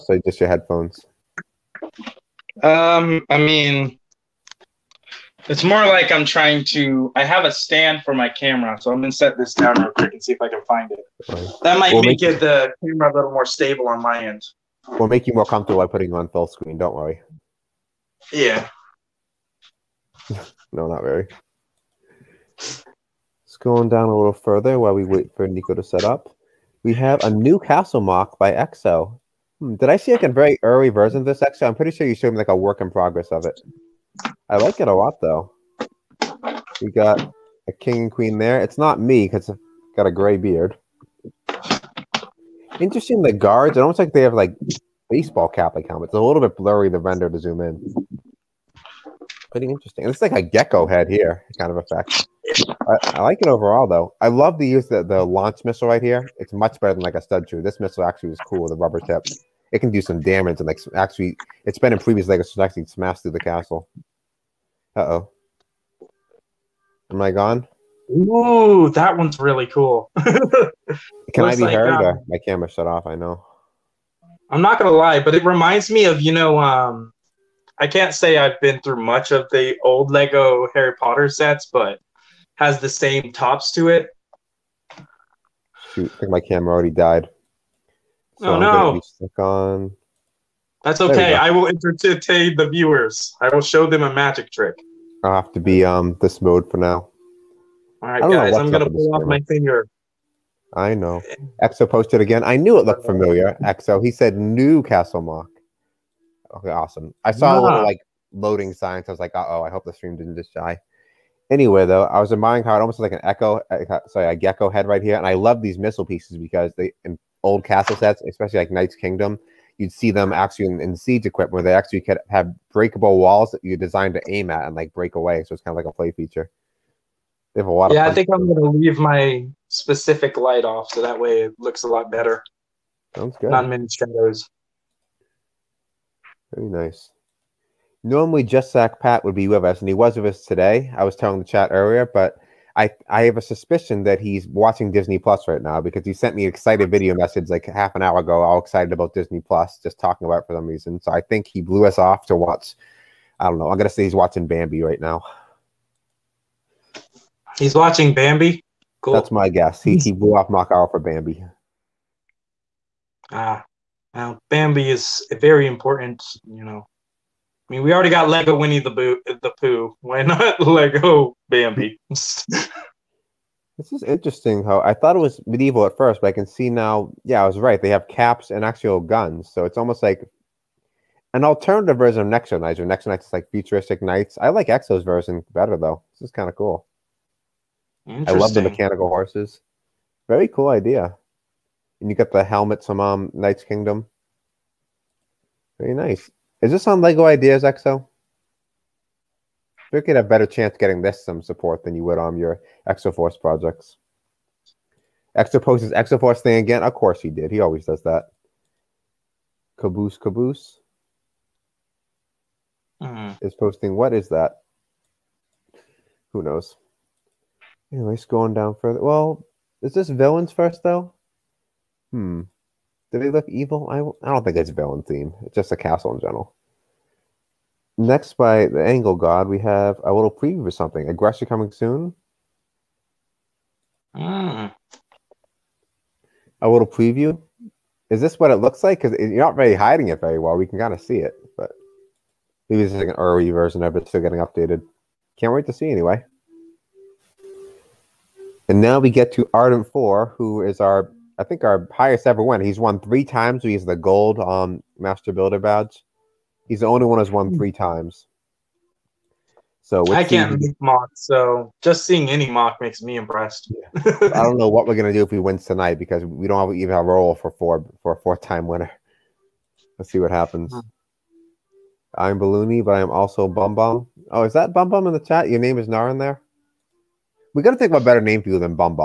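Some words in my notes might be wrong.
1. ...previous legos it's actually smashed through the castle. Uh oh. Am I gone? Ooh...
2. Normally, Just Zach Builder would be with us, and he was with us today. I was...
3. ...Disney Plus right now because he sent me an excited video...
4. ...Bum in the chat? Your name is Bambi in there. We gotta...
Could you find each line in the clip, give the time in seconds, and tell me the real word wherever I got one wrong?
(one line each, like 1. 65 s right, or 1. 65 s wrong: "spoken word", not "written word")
1. 61 s right
2. 138 s wrong: "Pat", not "Builder"
3. 144 s right
4. 274 s wrong: "Nar", not "Bambi".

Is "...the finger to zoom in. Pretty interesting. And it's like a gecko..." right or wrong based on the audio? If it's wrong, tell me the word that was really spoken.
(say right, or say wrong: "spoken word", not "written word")
wrong: "render", not "finger".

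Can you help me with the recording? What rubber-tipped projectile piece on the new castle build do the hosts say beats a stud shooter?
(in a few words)
launch missile.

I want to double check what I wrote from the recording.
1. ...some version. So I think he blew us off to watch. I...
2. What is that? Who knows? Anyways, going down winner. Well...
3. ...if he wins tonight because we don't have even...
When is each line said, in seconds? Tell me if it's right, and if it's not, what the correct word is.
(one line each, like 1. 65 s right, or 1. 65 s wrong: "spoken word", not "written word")
1. 150 s wrong: "reason", not "version"
2. 213 s wrong: "further", not "winner"
3. 265 s right.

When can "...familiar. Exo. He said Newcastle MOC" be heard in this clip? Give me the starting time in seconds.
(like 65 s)
103 s.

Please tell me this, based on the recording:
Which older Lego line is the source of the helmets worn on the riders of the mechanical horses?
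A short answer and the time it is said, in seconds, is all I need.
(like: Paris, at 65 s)
Knights Kingdom, at 193 s.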